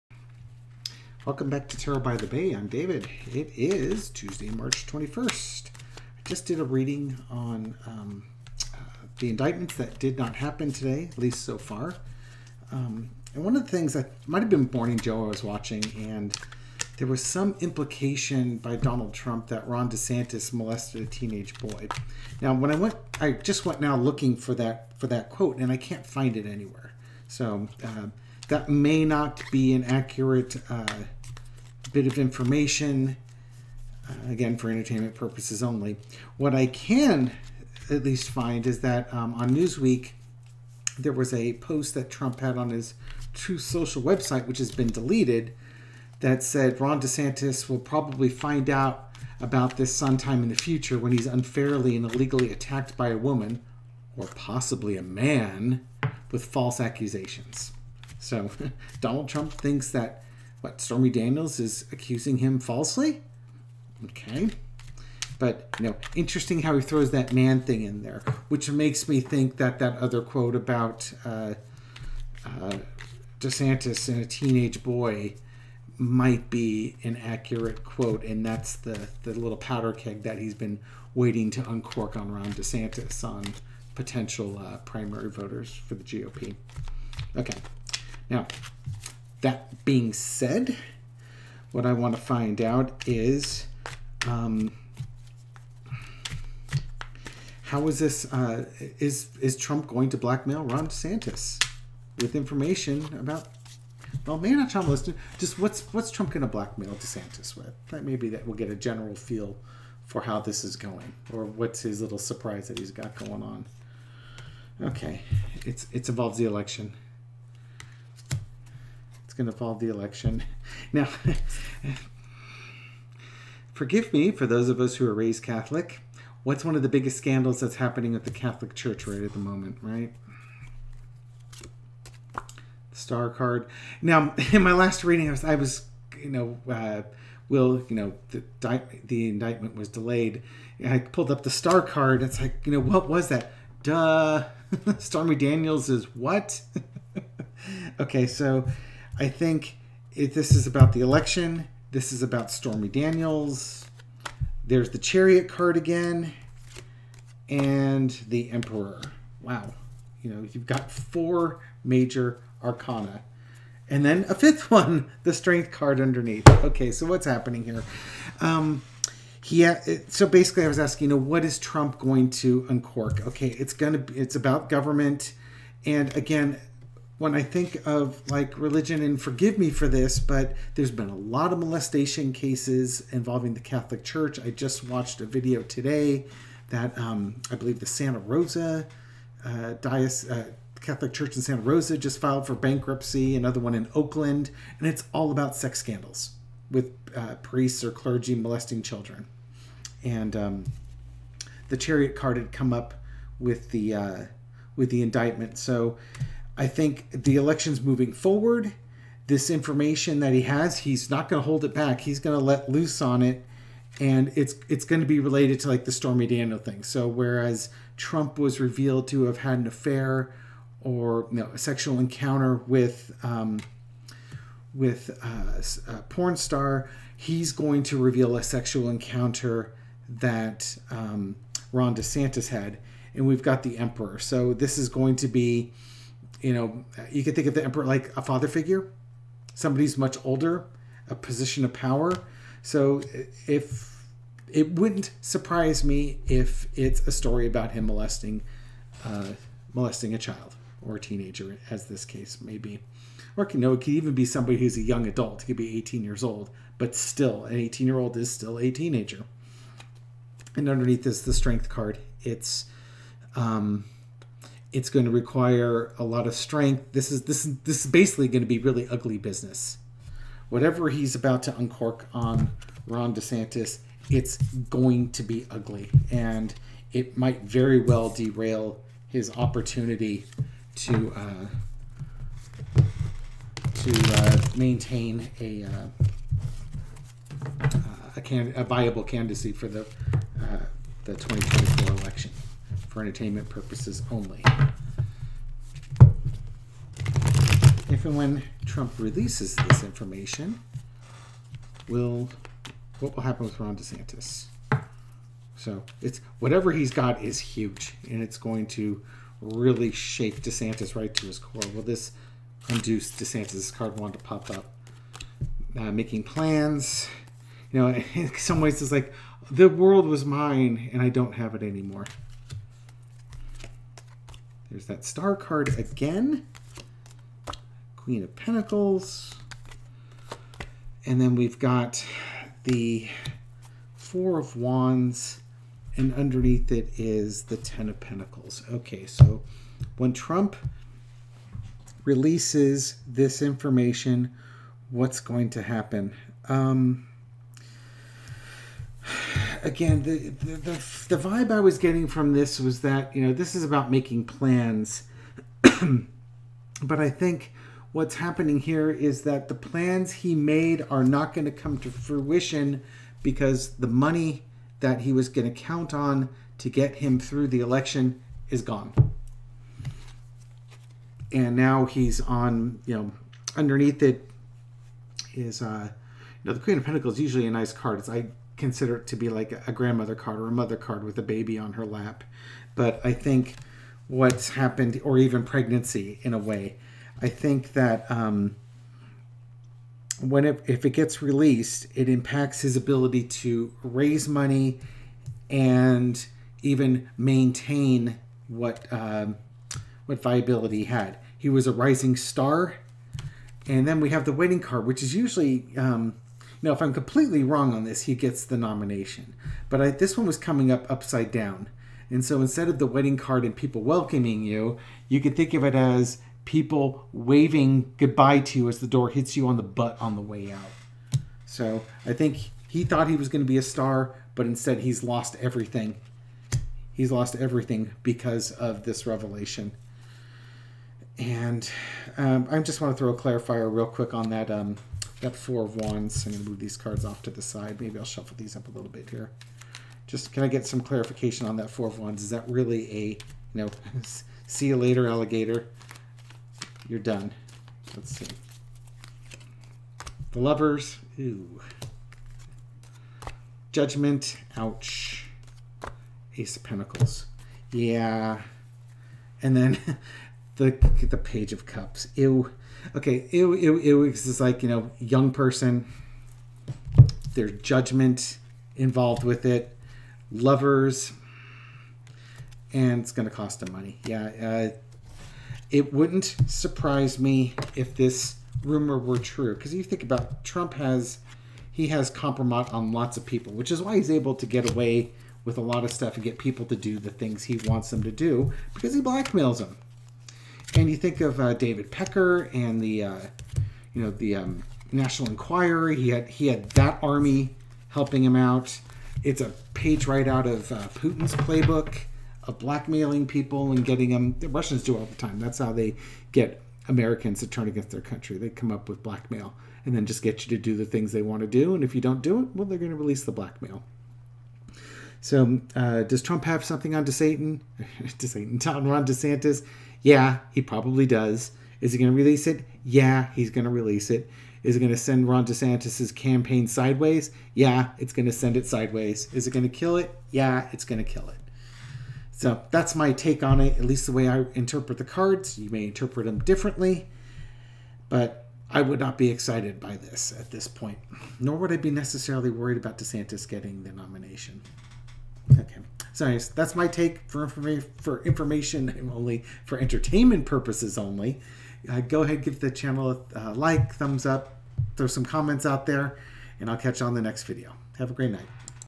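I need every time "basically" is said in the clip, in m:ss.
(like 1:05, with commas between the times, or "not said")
2:50, 4:27.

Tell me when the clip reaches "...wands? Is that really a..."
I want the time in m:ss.
7:21.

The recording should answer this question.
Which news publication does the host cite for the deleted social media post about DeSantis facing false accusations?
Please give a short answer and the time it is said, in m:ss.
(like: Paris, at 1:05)
Newsweek, at 0:39.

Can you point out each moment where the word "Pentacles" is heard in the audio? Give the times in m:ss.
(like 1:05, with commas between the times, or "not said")
5:28, 5:37, 6:16, 7:36.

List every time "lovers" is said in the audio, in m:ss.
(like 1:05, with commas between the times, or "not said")
7:30, 7:50.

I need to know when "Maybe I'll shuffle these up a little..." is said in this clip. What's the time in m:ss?
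7:17.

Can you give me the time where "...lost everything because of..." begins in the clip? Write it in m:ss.
7:07.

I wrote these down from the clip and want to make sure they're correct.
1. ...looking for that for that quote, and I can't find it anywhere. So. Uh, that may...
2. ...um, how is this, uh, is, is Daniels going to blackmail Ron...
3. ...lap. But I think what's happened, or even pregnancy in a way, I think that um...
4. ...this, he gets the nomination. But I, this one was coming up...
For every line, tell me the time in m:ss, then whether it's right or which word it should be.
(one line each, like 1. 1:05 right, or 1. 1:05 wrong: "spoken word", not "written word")
1. 0:23 right
2. 1:34 wrong: "Trump", not "Daniels"
3. 6:21 right
4. 6:47 right.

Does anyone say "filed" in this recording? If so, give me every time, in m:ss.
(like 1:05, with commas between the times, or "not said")
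3:12.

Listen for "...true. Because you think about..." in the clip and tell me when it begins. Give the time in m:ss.
7:59.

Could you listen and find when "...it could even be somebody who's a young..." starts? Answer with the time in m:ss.
4:13.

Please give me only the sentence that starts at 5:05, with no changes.
So it's whatever he's got is huge, and it's going to really shake DeSantis right to his core.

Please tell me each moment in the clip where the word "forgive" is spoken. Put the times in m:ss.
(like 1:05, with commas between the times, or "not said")
2:03, 2:59.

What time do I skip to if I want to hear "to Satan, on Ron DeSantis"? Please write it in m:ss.
8:38.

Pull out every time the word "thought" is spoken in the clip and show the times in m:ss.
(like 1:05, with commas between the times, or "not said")
7:02.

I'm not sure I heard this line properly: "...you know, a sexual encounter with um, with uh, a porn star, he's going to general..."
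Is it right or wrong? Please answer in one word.
wrong.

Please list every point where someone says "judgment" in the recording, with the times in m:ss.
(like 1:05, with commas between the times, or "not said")
7:33, 7:47.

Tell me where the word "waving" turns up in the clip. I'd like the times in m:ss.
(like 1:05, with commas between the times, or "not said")
6:57.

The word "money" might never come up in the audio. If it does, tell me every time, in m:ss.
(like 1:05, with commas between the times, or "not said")
6:03, 6:34, 7:53.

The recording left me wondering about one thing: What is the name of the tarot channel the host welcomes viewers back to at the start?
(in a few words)
Tarot by the Bay.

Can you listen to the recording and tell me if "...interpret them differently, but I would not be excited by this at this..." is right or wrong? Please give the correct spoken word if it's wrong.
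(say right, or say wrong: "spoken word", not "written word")
right.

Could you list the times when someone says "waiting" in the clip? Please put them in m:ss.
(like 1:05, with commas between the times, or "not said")
1:21.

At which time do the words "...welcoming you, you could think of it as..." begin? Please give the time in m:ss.
6:53.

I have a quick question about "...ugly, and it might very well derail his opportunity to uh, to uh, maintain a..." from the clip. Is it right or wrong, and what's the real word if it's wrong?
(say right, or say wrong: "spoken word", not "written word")
right.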